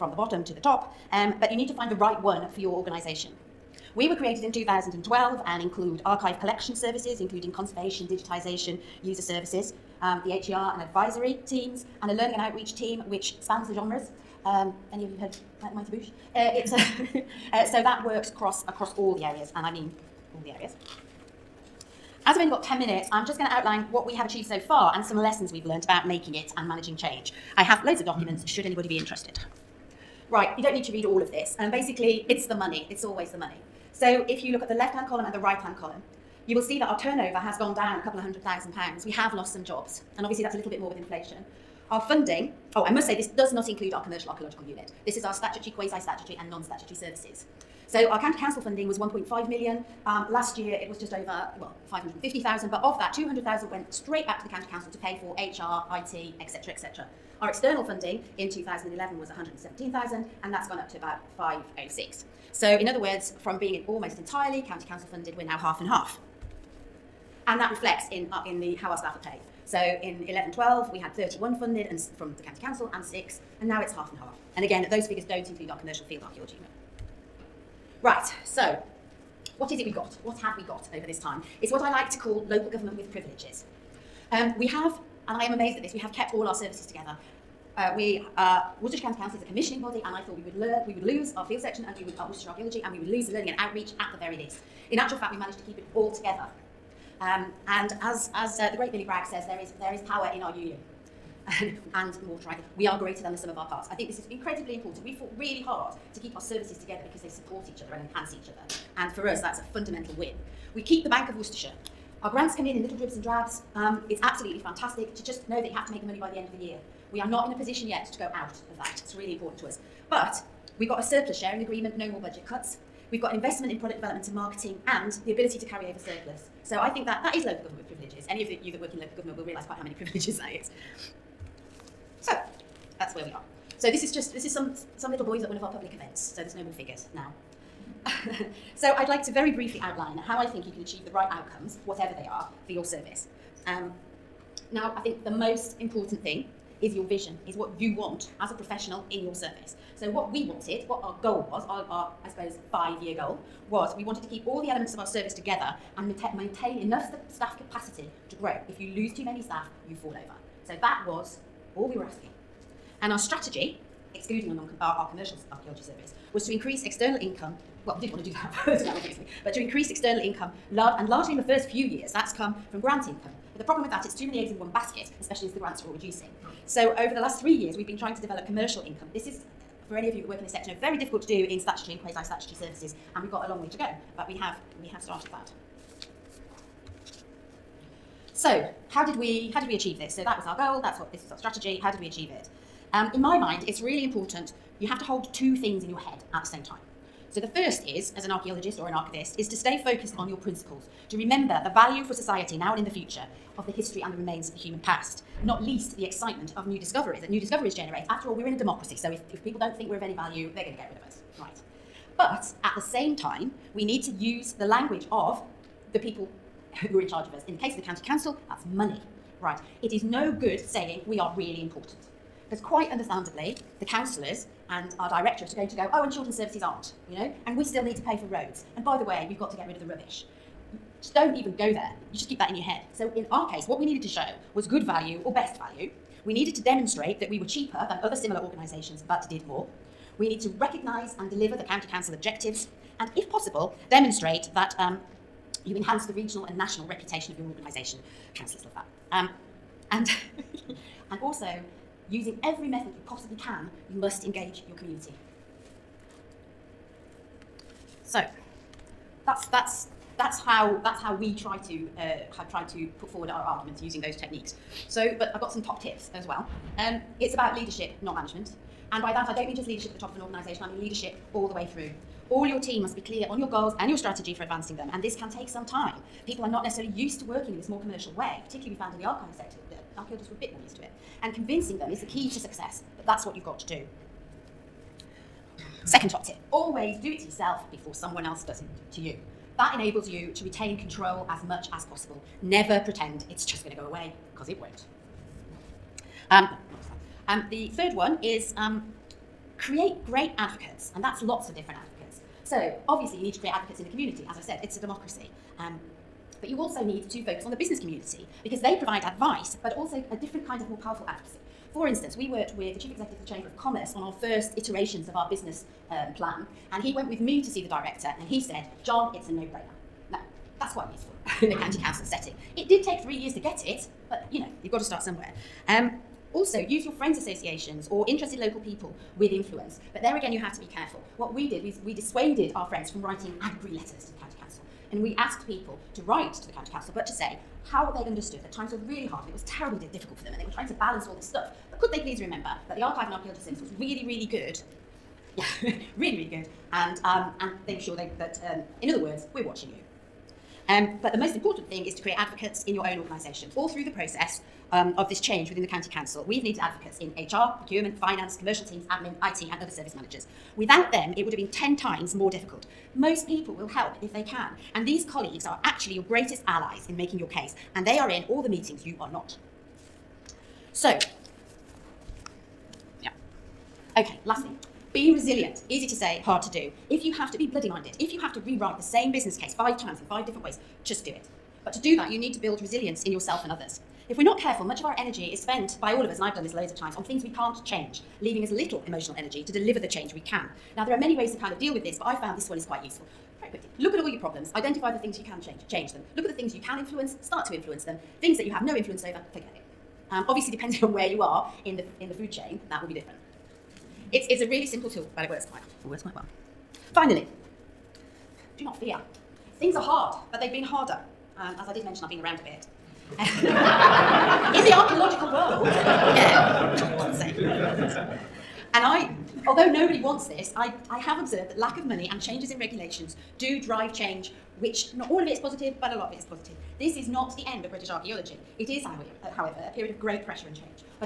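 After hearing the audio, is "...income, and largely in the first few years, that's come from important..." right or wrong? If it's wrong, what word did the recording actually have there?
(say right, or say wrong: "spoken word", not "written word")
wrong: "grant", not "important".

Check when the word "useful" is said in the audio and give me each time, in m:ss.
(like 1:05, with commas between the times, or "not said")
5:20, 6:32.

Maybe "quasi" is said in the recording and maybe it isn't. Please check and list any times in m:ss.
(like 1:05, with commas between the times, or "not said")
0:45, 3:02.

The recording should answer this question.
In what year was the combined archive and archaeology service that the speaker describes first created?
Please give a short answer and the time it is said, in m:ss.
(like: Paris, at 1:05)
2012, at 0:04.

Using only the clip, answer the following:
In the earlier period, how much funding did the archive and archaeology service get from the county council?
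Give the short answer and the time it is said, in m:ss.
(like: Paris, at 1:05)
1.5 million, at 0:48.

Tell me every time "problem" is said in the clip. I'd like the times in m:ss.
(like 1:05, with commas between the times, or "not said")
2:53, 6:34.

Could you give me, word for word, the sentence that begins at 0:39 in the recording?
We have lost some jobs, and obviously that's a little bit more with inflation.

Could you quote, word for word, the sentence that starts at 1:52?
Our grants come in in little dribs and drabs.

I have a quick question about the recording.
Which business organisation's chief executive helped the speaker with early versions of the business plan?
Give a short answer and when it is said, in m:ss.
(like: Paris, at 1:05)
Chamber of Commerce, at 5:13.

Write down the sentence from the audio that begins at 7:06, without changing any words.
This is not the end of British archaeology.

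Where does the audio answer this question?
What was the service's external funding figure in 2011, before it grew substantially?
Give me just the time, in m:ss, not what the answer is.
0:59.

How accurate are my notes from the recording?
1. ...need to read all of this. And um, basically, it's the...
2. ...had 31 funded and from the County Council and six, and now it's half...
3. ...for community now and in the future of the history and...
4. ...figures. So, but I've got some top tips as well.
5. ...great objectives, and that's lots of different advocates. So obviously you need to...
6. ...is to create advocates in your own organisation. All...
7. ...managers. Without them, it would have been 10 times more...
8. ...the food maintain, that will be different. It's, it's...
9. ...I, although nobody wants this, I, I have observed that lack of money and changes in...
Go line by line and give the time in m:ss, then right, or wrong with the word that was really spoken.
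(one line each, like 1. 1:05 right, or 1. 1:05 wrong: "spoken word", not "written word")
1. 0:30 right
2. 1:10 right
3. 3:22 wrong: "society", not "community"
4. 4:24 wrong: "techniques", not "figures"
5. 5:00 wrong: "advocates", not "objectives"
6. 5:51 right
7. 5:59 right
8. 6:42 wrong: "chain", not "maintain"
9. 6:58 right.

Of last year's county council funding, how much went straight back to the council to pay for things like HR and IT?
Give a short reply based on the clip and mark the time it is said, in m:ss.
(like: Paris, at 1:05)
200,000, at 0:53.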